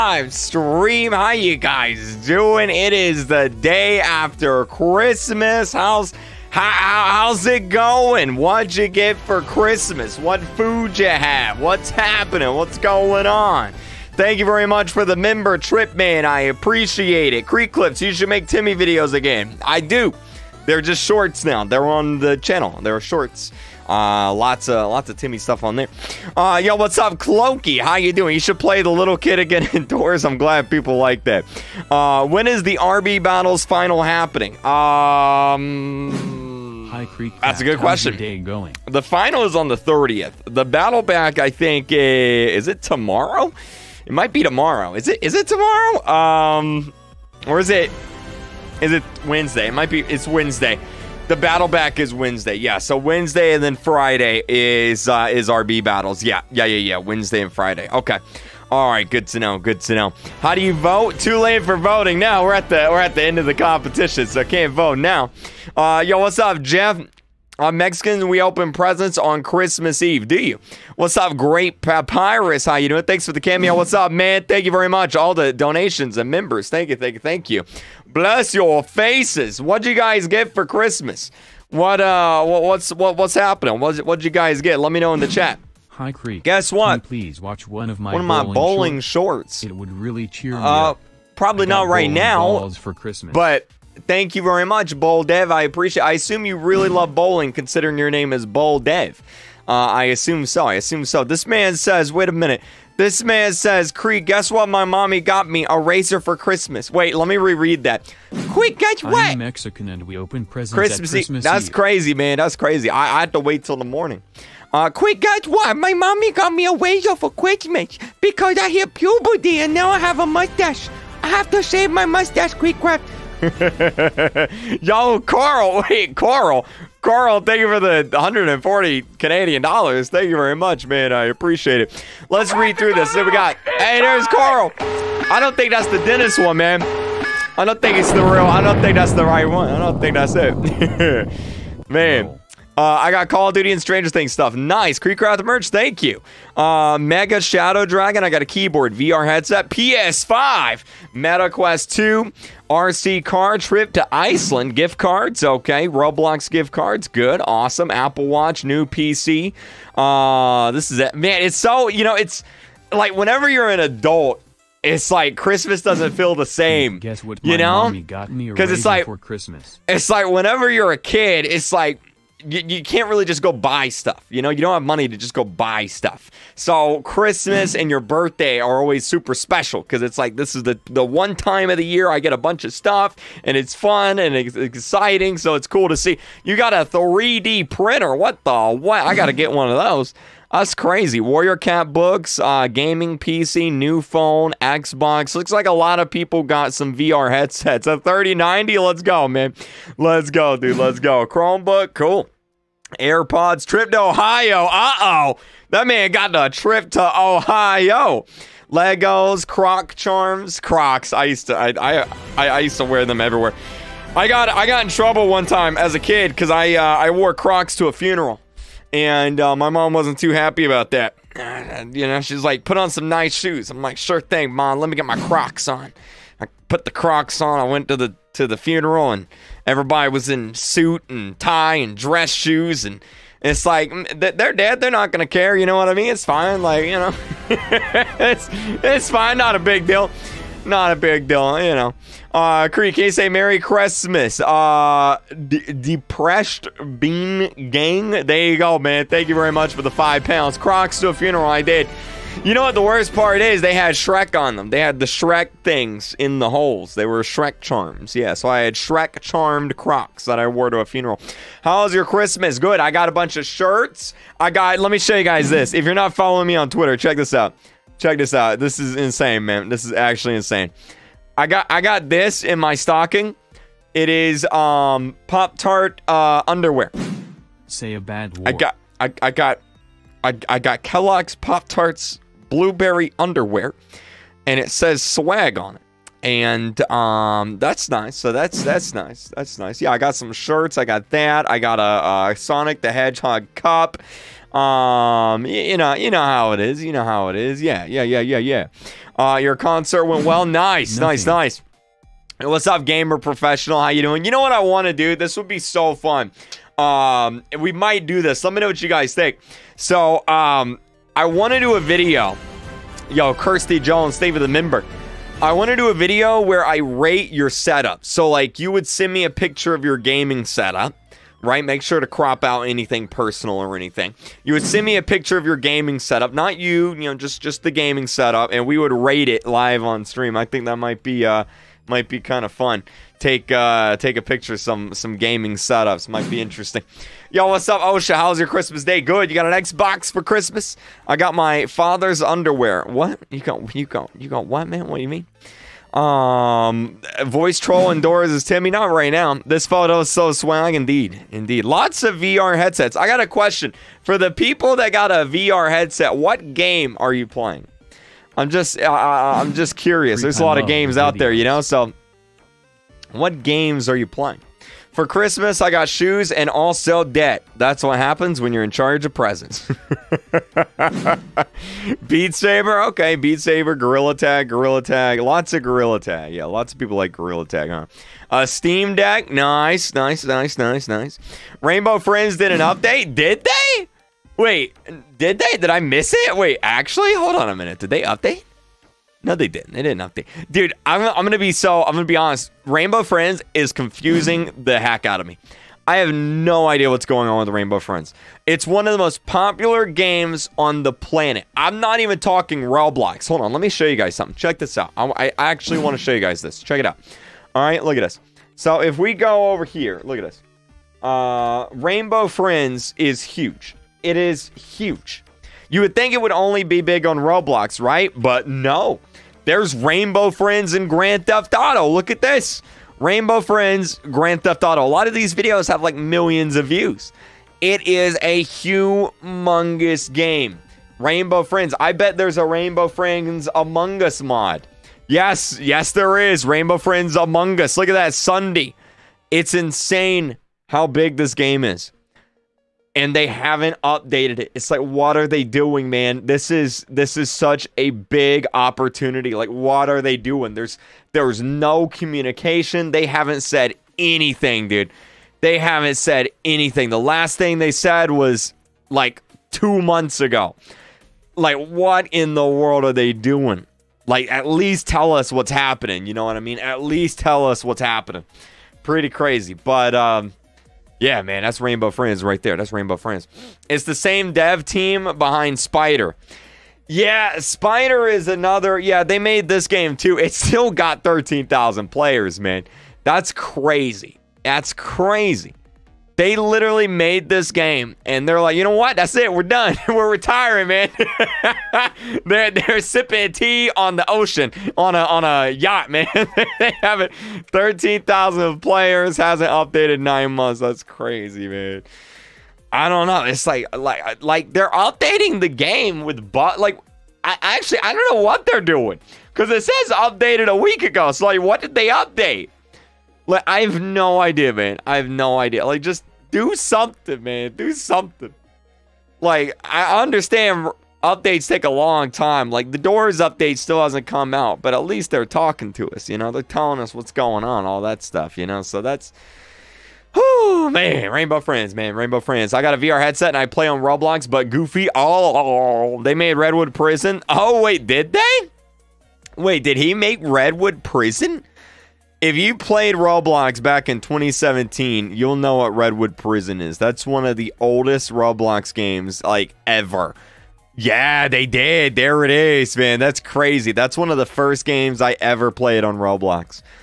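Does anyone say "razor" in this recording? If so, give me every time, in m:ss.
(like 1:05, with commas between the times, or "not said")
1:45, 1:56.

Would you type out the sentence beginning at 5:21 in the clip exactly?
Make sure to crop out anything personal or anything.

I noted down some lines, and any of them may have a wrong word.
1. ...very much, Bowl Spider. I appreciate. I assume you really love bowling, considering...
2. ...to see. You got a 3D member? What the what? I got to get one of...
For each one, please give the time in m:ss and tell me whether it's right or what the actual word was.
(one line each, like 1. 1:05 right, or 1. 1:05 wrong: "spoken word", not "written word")
1. 1:34 wrong: "Dev", not "Spider"
2. 3:05 wrong: "printer", not "member".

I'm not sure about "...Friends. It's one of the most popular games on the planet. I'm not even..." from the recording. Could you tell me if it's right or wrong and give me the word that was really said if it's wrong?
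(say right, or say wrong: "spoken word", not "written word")
right.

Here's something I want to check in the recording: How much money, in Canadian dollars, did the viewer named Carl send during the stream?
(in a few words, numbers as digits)
140.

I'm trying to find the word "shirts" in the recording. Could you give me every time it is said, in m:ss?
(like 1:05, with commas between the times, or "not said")
4:23, 4:50.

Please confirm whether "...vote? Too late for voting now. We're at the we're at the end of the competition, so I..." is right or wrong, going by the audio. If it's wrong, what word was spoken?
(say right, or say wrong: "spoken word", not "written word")
right.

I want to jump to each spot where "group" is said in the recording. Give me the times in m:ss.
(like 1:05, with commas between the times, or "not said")
not said.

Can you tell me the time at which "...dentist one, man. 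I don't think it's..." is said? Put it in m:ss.
2:16.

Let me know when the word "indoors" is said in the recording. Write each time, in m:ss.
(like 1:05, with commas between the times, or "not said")
0:29, 5:47.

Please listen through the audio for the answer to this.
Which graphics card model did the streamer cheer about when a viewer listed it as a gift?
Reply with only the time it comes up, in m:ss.
3:17.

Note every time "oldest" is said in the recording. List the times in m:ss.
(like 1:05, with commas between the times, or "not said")
9:07.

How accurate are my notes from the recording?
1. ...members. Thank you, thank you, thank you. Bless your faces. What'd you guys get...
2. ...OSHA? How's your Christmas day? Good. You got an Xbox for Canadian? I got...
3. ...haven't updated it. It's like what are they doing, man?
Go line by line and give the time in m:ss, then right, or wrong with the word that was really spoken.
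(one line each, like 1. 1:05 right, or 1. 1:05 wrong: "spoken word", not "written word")
1. 1:16 right
2. 5:37 wrong: "Christmas", not "Canadian"
3. 7:23 right.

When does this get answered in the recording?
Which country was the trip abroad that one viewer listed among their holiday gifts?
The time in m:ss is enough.
2:33.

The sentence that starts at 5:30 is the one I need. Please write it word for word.
I think that might be uh might be kind of fun.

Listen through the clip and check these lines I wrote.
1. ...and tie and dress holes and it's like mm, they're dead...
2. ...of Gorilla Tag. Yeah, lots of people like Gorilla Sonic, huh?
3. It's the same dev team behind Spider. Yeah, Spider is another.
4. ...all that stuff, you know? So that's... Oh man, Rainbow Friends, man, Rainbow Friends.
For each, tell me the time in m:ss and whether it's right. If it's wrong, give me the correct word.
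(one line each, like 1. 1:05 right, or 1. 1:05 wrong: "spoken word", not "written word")
1. 3:51 wrong: "shoes", not "holes"
2. 6:15 wrong: "Tag", not "Sonic"
3. 7:53 right
4. 8:47 right.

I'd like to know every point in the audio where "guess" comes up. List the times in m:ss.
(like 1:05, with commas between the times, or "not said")
1:26, 1:44, 1:48, 1:55, 2:46.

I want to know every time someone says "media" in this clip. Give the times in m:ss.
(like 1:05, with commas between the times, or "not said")
not said.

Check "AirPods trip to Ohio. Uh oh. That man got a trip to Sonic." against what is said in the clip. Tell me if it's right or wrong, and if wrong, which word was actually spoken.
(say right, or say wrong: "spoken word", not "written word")
wrong: "Ohio", not "Sonic".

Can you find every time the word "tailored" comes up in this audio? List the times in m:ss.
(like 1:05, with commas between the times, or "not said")
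not said.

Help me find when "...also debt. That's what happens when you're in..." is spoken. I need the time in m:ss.
6:06.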